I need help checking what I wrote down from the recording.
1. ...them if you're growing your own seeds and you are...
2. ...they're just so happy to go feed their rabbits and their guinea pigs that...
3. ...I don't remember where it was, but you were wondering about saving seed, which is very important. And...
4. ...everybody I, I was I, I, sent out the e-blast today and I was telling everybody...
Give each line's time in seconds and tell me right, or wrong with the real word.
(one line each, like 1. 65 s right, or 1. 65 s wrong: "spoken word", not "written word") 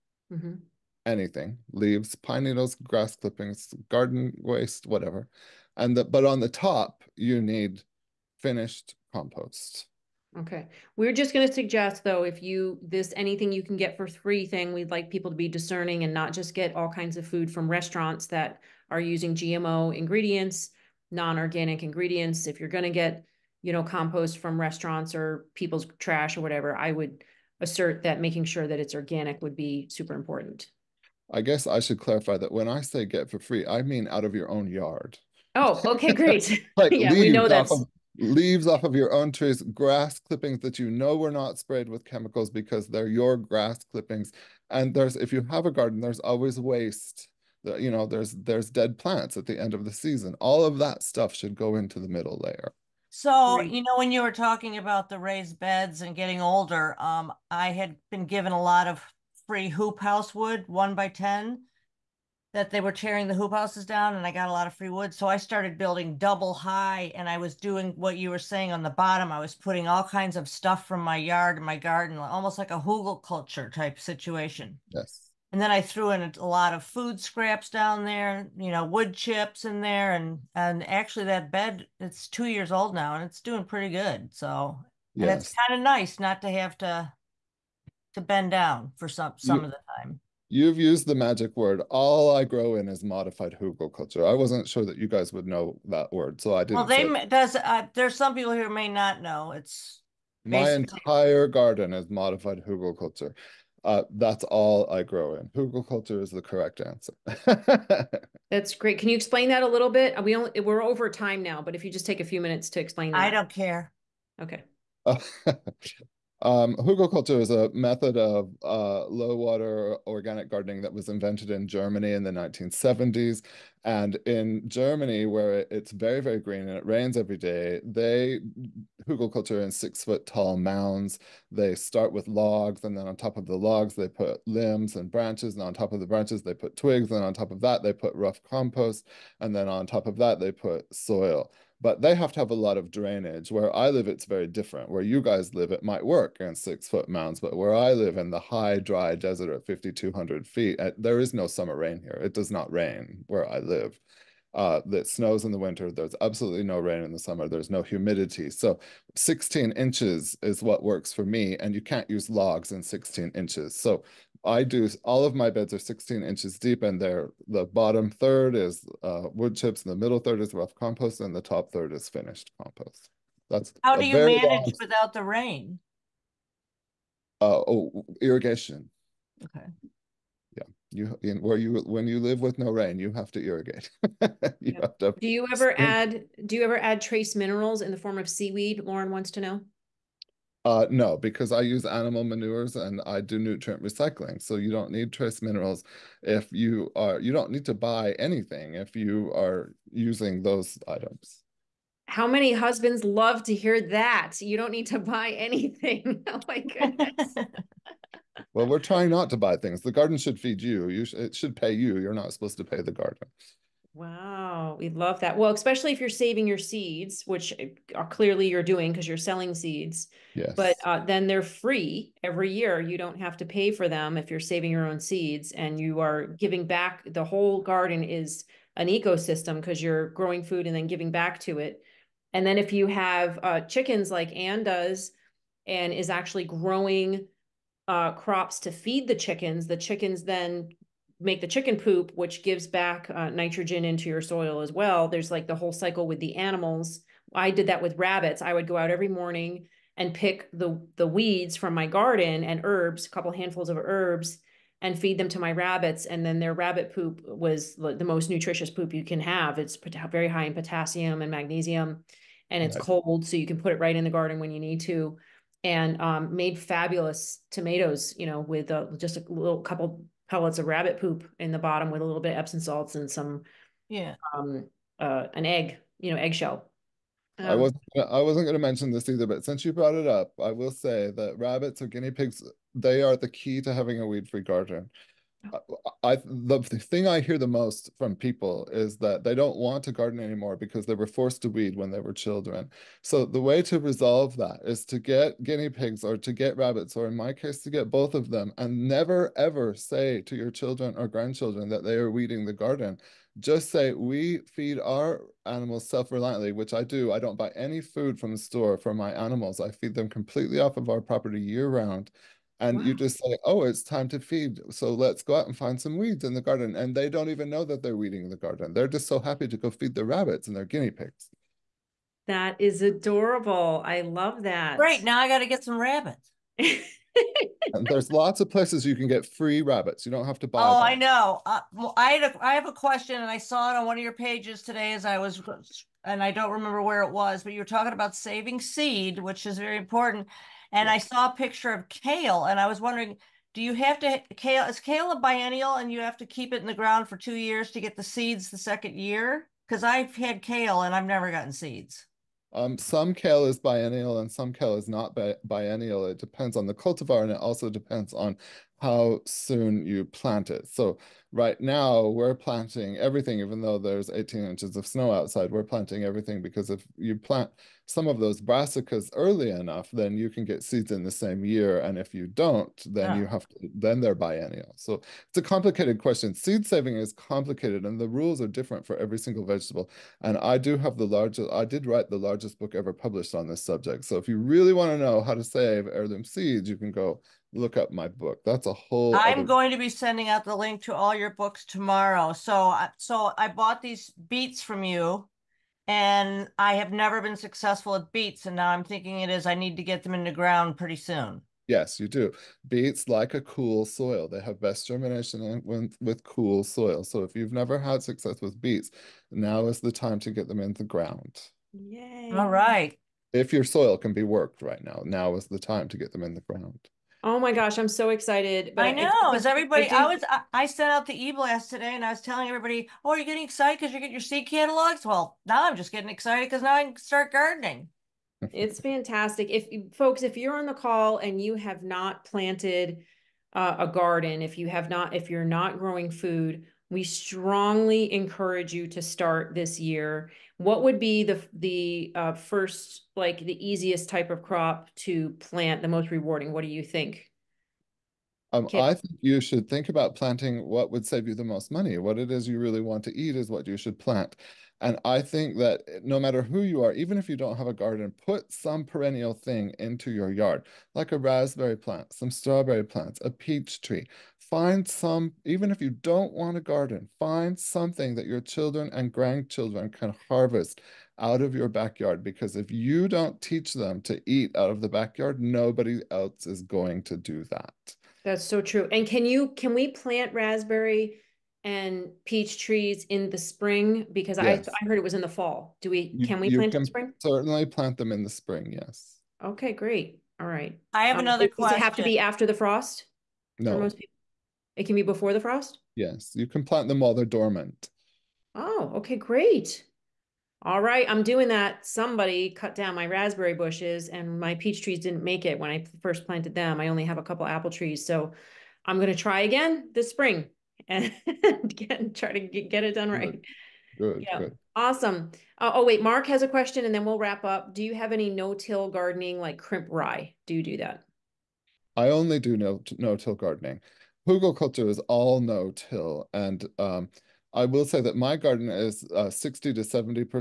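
1. 223 s wrong: "saving", not "growing"
2. 318 s right
3. 336 s wrong: "talking", not "wondering"
4. 419 s right.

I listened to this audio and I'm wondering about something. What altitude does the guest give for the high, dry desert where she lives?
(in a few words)
5,200 feet.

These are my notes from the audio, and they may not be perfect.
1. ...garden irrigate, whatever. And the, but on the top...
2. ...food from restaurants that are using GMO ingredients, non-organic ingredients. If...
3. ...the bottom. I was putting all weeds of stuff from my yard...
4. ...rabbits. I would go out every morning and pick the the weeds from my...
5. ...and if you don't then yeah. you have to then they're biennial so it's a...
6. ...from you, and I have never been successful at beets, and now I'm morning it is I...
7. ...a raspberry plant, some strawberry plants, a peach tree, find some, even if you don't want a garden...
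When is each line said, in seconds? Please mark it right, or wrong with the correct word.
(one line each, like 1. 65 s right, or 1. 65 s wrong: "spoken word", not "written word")
1. 3 s wrong: "waste", not "irrigate"
2. 17 s right
3. 68 s wrong: "kinds", not "weeds"
4. 247 s right
5. 371 s right
6. 394 s wrong: "thinking", not "morning"
7. 461 s right.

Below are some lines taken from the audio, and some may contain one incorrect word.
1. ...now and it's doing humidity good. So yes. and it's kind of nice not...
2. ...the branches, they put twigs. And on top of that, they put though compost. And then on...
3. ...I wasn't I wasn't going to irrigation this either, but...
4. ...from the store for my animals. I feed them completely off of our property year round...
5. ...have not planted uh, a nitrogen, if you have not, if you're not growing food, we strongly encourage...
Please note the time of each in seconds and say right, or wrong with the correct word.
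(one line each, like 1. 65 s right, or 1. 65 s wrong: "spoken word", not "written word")
1. 82 s wrong: "pretty", not "humidity"
2. 136 s wrong: "rough", not "though"
3. 277 s wrong: "mention", not "irrigation"
4. 308 s right
5. 431 s wrong: "garden", not "nitrogen".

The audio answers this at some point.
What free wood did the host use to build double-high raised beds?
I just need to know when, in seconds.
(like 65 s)
59 s.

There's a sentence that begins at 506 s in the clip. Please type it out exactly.
I only have a couple apple trees.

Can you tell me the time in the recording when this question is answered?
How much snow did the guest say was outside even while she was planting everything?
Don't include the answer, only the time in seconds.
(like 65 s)
364 s.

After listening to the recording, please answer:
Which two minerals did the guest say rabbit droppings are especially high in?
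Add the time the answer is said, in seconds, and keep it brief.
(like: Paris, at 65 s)
potassium and magnesium, at 260 s.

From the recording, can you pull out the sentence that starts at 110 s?
We only we're over time now, but if you just take a few minutes to explain that.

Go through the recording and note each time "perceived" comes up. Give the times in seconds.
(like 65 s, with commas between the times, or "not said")
not said.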